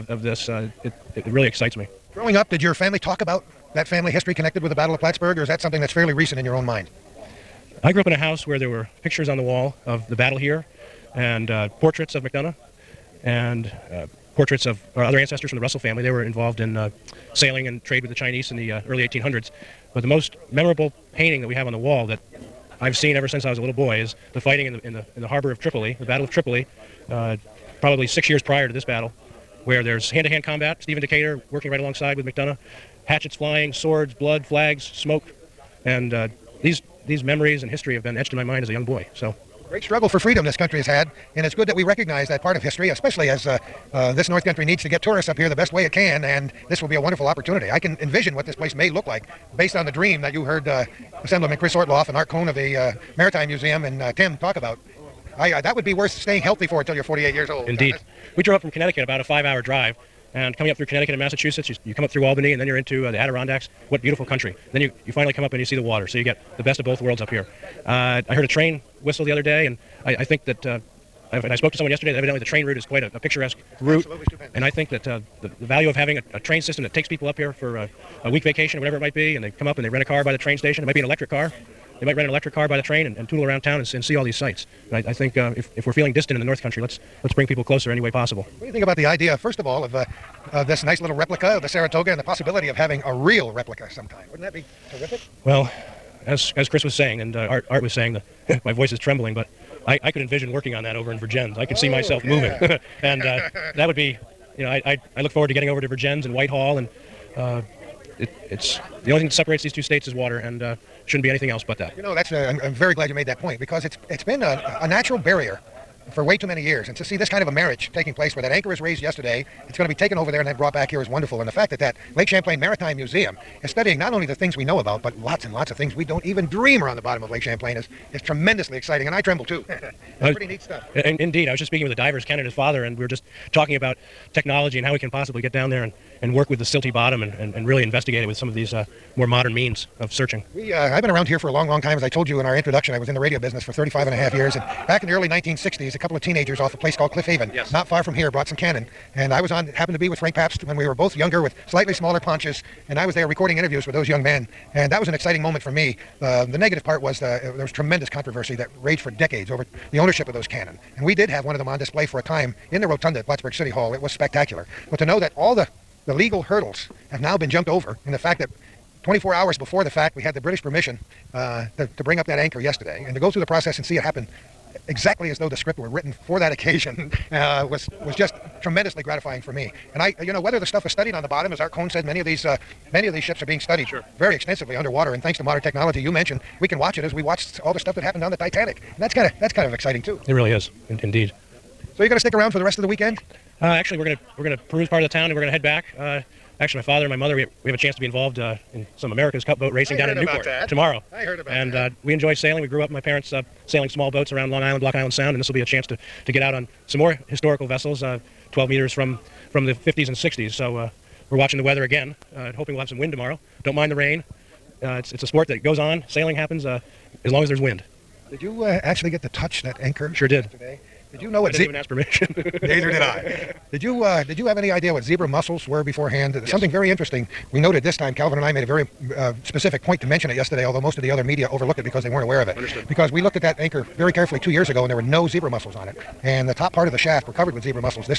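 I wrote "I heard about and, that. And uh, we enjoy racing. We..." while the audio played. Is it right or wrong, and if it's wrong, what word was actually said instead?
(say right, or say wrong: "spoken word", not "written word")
wrong: "sailing", not "racing".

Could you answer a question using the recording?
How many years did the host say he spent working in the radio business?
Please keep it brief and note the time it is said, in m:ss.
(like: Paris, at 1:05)
35 and a half, at 2:23.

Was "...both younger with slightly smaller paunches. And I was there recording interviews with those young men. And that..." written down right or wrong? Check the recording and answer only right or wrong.
right.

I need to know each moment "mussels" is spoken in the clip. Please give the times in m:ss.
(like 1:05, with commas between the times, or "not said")
3:45, 3:55.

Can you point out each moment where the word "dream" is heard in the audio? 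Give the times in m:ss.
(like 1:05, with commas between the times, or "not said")
0:49, 2:06.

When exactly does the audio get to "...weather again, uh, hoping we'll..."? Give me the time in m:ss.
3:31.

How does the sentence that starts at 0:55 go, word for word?
I, that would be worth staying healthy for until you're 48 years old.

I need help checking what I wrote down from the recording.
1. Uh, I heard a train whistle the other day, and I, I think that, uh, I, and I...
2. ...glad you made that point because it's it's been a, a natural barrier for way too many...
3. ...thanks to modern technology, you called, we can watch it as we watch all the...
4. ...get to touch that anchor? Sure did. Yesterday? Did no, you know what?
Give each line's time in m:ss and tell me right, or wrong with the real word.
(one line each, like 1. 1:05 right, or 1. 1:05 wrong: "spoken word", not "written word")
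1. 1:07 right
2. 1:52 right
3. 3:05 wrong: "mentioned", not "called"
4. 3:39 right.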